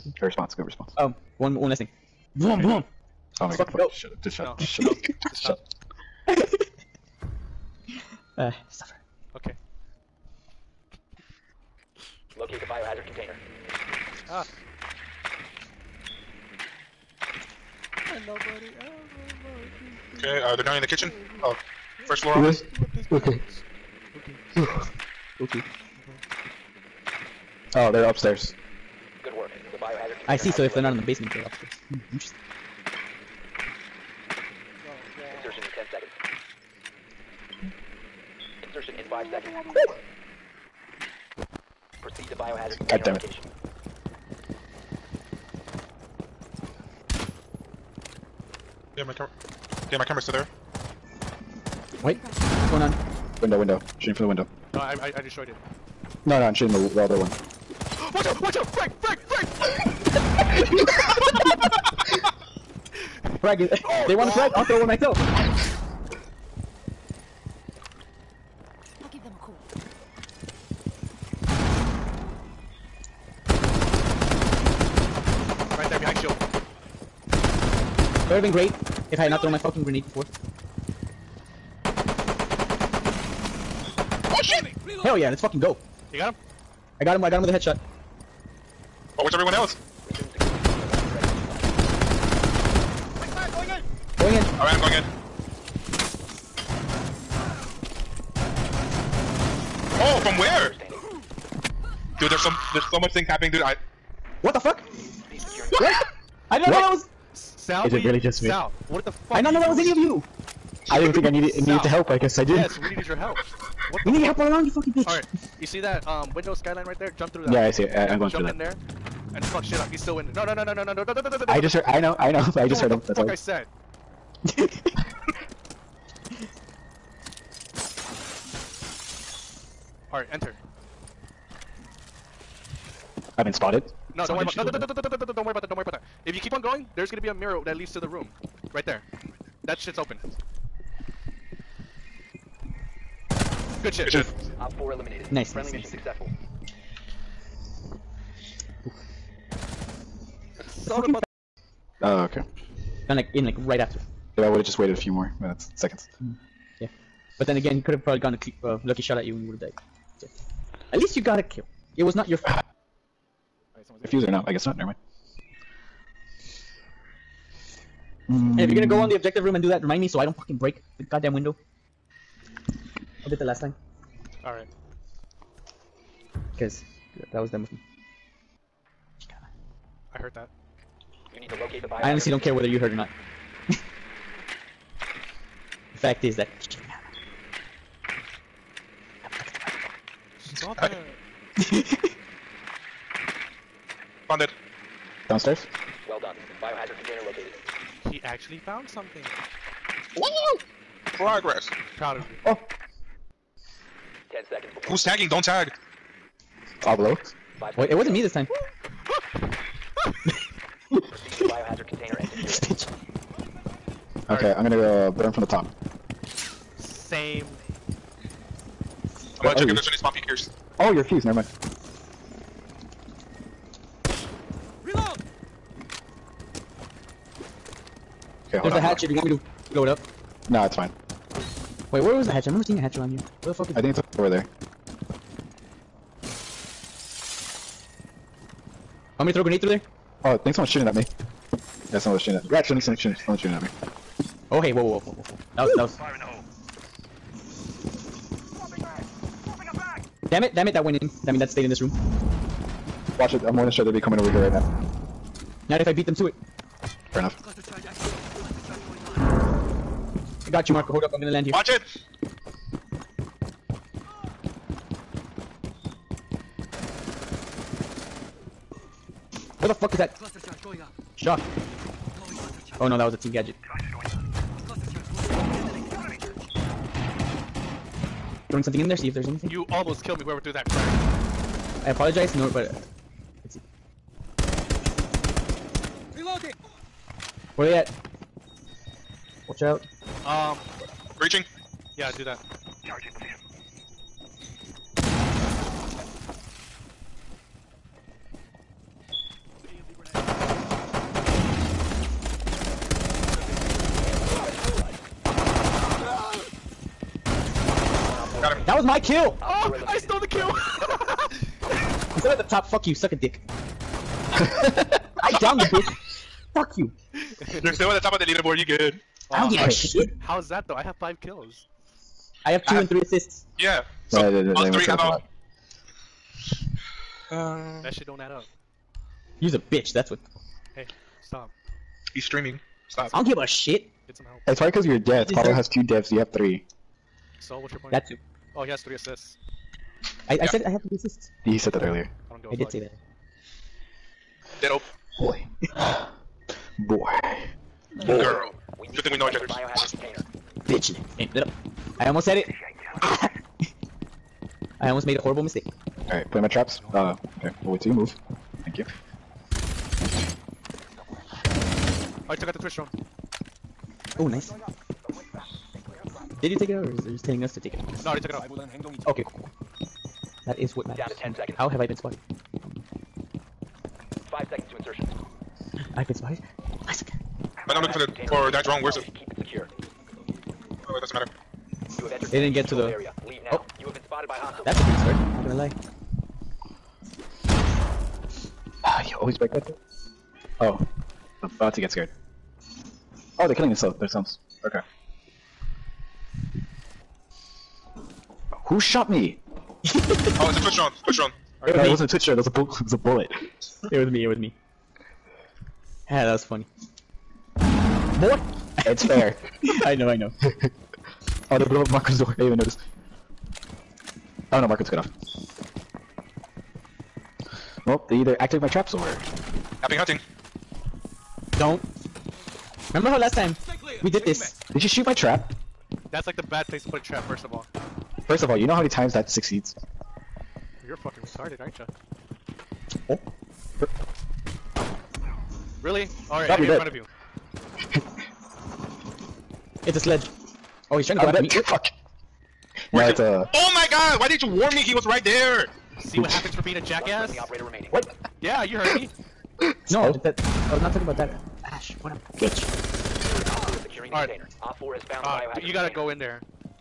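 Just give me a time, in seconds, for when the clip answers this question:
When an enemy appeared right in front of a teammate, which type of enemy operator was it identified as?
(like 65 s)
439 s.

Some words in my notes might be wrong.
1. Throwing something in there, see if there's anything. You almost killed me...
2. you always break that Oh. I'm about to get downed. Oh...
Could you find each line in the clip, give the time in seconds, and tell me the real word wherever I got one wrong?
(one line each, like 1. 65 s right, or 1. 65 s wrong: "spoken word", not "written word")
1. 278 s right
2. 389 s wrong: "scared", not "downed".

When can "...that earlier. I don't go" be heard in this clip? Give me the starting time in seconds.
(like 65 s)
341 s.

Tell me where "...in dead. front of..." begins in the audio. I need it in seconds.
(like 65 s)
436 s.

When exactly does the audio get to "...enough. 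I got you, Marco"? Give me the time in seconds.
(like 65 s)
257 s.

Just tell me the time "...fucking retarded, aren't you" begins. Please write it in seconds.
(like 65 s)
430 s.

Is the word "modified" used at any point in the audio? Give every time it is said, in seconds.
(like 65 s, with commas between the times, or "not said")
not said.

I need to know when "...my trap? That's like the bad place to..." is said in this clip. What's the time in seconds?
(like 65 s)
425 s.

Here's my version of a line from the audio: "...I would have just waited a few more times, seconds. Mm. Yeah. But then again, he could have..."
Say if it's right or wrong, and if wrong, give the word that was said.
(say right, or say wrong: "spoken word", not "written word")
wrong: "minutes", not "times".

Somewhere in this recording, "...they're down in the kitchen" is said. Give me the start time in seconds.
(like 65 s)
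20 s.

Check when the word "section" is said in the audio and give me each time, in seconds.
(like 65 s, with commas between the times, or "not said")
not said.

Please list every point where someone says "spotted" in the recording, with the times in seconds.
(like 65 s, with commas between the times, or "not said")
133 s, 371 s, 376 s, 384 s.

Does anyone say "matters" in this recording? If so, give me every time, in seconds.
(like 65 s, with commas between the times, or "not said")
370 s, 381 s.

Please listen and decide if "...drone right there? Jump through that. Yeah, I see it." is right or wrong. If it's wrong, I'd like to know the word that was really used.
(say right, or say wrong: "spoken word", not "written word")
wrong: "skyline", not "drone".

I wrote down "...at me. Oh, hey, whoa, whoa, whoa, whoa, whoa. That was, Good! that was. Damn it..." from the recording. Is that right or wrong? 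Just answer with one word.
wrong.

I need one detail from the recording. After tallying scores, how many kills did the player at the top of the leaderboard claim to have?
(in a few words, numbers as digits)
5.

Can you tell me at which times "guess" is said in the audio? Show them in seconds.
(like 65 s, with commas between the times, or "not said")
112 s, 164 s.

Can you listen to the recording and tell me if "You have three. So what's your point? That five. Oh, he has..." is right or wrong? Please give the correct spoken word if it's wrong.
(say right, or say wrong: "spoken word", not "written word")
wrong: "two", not "five".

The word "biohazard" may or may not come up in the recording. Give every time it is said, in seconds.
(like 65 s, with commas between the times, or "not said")
12 s, 29 s, 42 s, 196 s.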